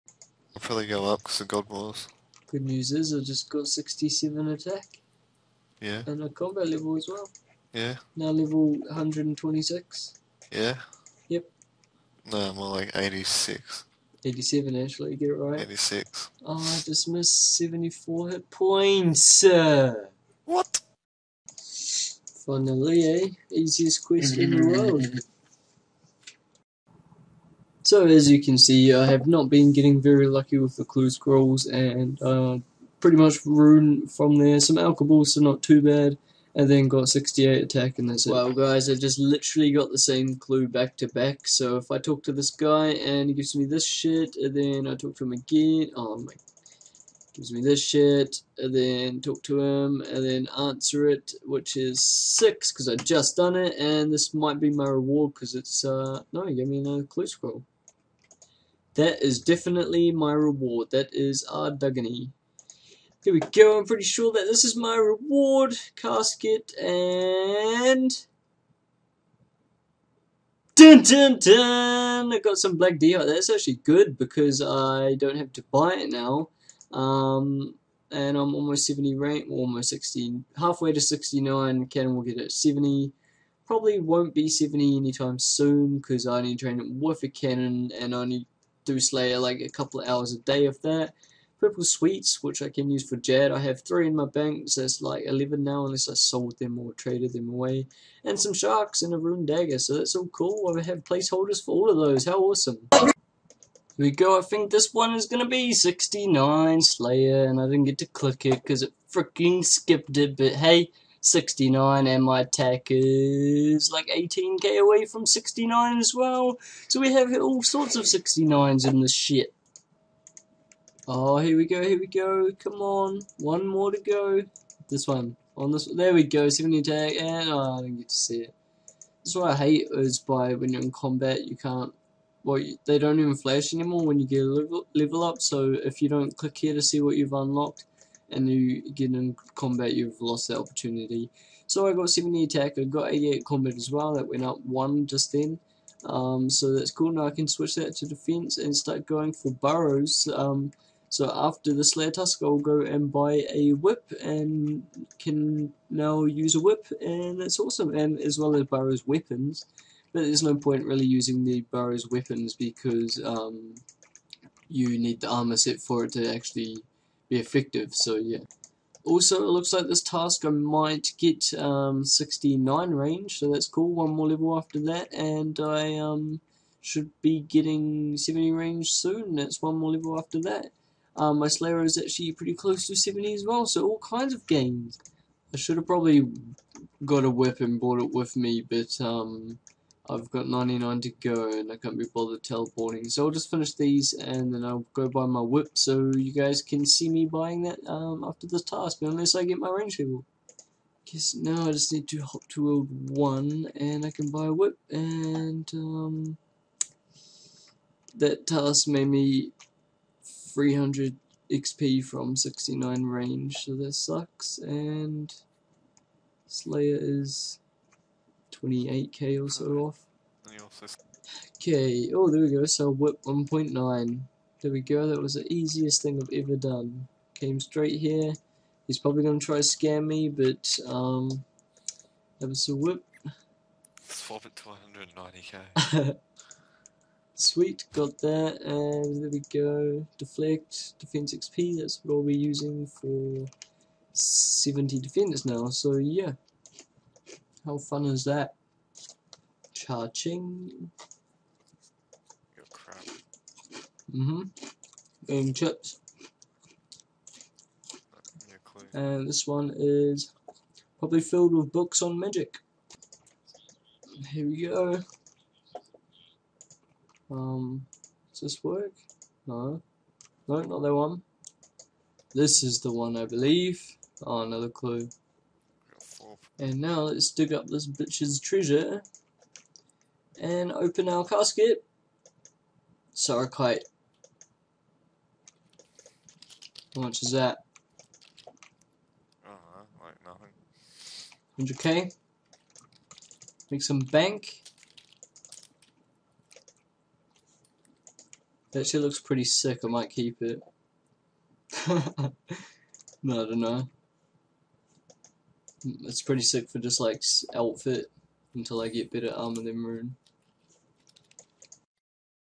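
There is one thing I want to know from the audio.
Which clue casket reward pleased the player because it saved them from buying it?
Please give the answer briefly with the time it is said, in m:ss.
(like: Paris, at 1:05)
Black DI, at 1:12.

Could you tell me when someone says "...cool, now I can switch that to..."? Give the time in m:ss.
2:26.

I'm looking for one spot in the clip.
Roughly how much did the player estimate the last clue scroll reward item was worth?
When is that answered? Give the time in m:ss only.
4:51.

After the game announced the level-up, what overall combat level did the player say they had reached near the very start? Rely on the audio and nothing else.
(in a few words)
126.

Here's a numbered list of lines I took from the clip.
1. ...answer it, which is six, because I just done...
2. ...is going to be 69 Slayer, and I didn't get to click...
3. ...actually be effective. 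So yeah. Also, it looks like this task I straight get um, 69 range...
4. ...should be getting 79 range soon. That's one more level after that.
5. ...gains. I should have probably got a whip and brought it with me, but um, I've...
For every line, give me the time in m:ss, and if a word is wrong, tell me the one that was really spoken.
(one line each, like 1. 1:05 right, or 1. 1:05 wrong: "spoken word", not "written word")
1. 0:50 right
2. 1:45 right
3. 2:46 wrong: "might", not "straight"
4. 2:56 wrong: "70", not "79"
5. 3:04 right.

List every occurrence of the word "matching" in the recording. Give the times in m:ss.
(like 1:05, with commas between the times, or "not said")
not said.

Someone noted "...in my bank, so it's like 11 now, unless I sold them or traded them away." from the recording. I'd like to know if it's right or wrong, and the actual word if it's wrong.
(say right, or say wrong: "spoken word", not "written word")
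right.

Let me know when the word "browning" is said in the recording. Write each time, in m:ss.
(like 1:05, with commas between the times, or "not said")
not said.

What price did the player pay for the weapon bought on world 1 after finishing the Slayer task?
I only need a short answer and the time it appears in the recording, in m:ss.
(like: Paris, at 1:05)
1.9, at 3:43.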